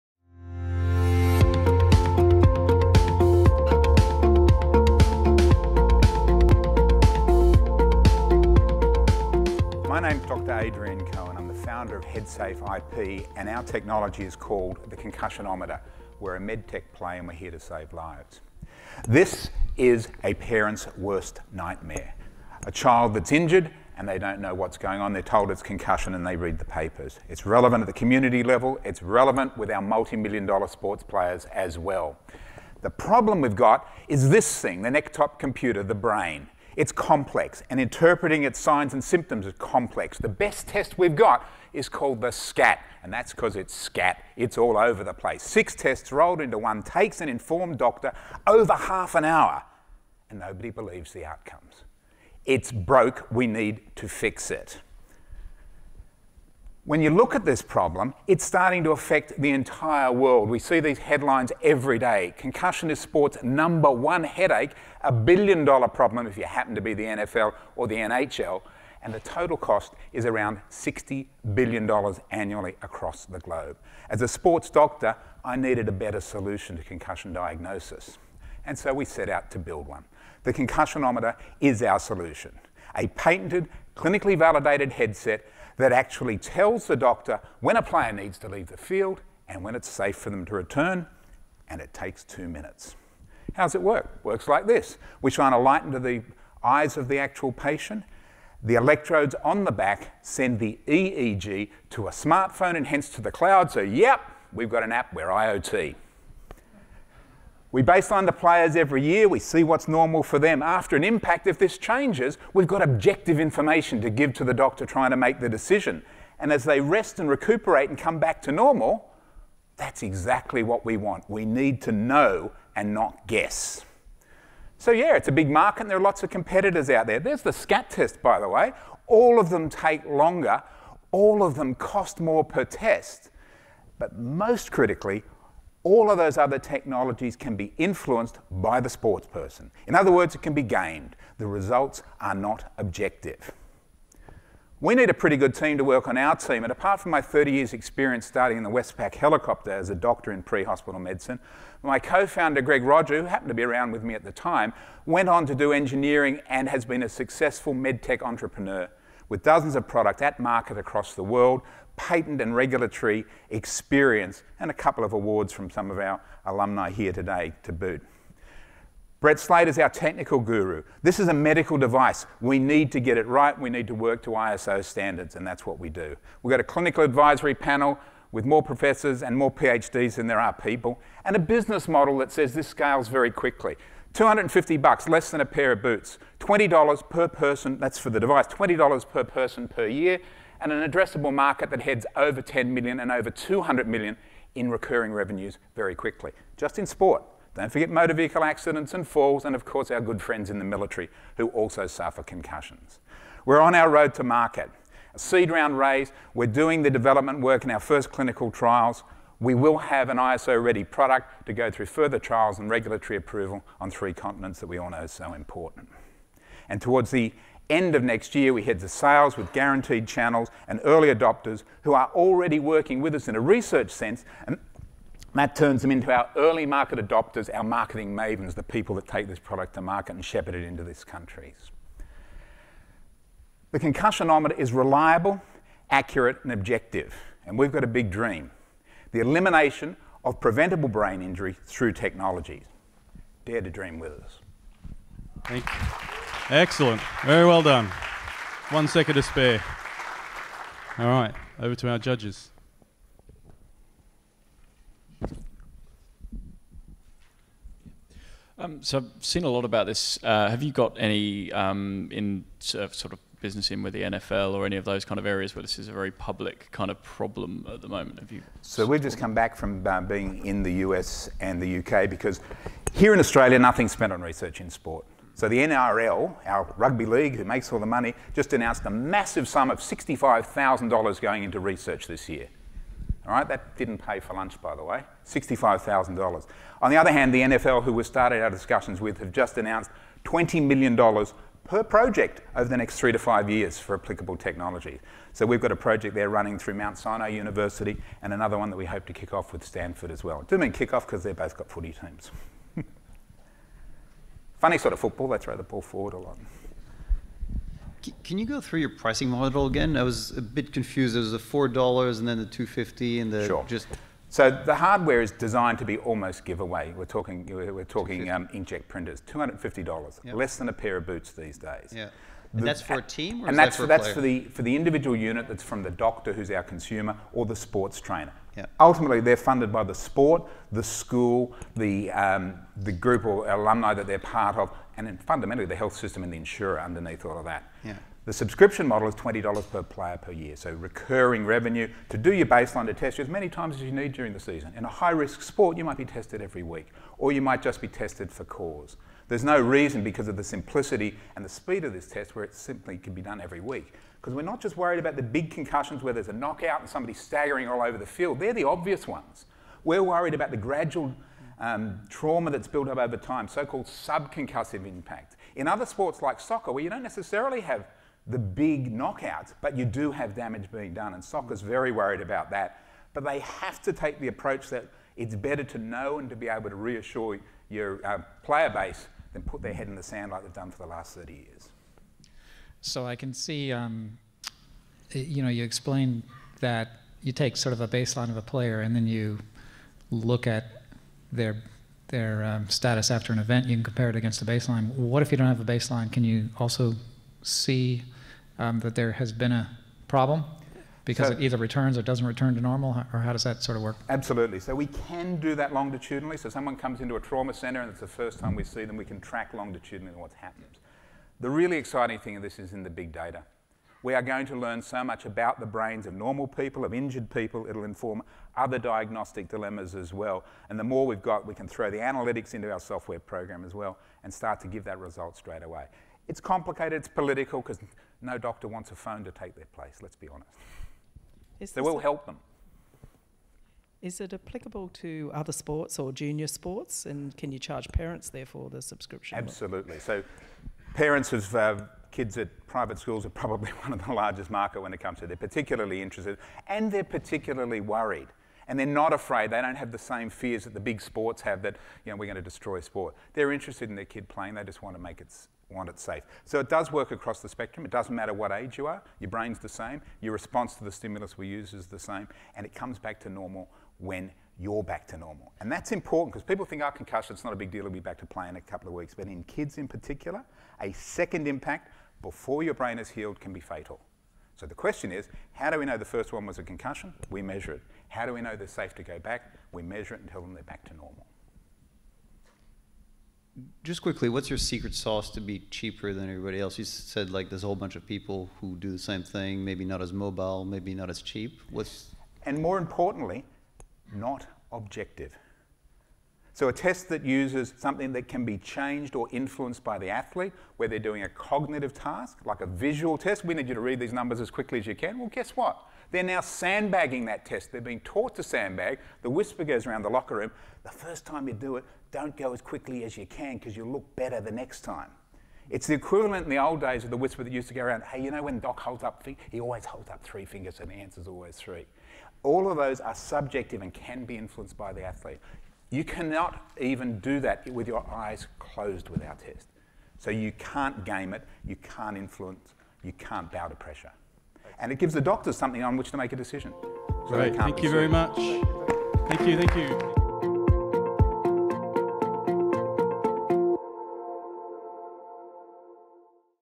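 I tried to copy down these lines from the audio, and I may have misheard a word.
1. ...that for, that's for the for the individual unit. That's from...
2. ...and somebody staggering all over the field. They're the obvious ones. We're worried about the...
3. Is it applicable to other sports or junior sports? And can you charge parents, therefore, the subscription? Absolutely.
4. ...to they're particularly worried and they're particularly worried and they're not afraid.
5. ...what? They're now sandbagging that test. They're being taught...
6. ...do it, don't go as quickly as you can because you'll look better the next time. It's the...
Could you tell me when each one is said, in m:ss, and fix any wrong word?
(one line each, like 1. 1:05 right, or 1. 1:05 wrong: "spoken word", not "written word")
1. 5:23 right
2. 5:56 right
3. 7:14 right
4. 7:25 wrong: "interested", not "worried"
5. 8:25 right
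6. 8:31 right.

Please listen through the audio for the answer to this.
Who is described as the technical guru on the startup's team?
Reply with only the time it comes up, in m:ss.
2:49.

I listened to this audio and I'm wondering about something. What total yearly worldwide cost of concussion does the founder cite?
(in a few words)
$60 billion.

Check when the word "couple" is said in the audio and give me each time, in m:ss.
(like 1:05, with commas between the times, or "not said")
2:44, 7:48.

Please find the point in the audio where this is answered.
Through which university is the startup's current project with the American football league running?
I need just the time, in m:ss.
4:56.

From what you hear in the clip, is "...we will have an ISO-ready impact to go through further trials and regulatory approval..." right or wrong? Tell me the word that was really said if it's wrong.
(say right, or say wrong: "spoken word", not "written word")
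wrong: "product", not "impact".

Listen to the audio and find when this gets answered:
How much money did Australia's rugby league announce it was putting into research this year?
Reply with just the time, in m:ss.
4:39.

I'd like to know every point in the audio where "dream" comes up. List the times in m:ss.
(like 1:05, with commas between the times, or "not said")
3:58, 4:03.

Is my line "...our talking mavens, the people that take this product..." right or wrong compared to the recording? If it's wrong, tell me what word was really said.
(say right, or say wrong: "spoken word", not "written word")
wrong: "marketing", not "talking".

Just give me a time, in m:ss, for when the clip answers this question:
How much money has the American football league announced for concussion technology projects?
4:50.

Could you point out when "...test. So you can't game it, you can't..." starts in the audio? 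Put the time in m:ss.
8:49.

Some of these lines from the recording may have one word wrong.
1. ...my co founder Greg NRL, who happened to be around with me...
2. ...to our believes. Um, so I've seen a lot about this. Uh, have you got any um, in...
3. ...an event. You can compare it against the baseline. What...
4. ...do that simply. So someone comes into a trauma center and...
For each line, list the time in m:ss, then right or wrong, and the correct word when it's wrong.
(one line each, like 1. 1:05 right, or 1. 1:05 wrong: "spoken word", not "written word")
1. 2:31 wrong: "Roger", not "NRL"
2. 4:11 wrong: "judges", not "believes"
3. 6:33 right
4. 6:45 wrong: "longitudinally", not "simply".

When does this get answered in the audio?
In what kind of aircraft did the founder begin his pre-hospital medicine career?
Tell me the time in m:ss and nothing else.
2:28.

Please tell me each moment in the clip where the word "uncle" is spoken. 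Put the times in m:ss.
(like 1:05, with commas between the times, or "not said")
not said.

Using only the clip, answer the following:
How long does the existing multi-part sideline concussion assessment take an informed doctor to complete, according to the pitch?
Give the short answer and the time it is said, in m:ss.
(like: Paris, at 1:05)
over half an hour, at 0:48.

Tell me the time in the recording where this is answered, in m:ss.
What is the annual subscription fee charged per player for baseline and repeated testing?
5:39.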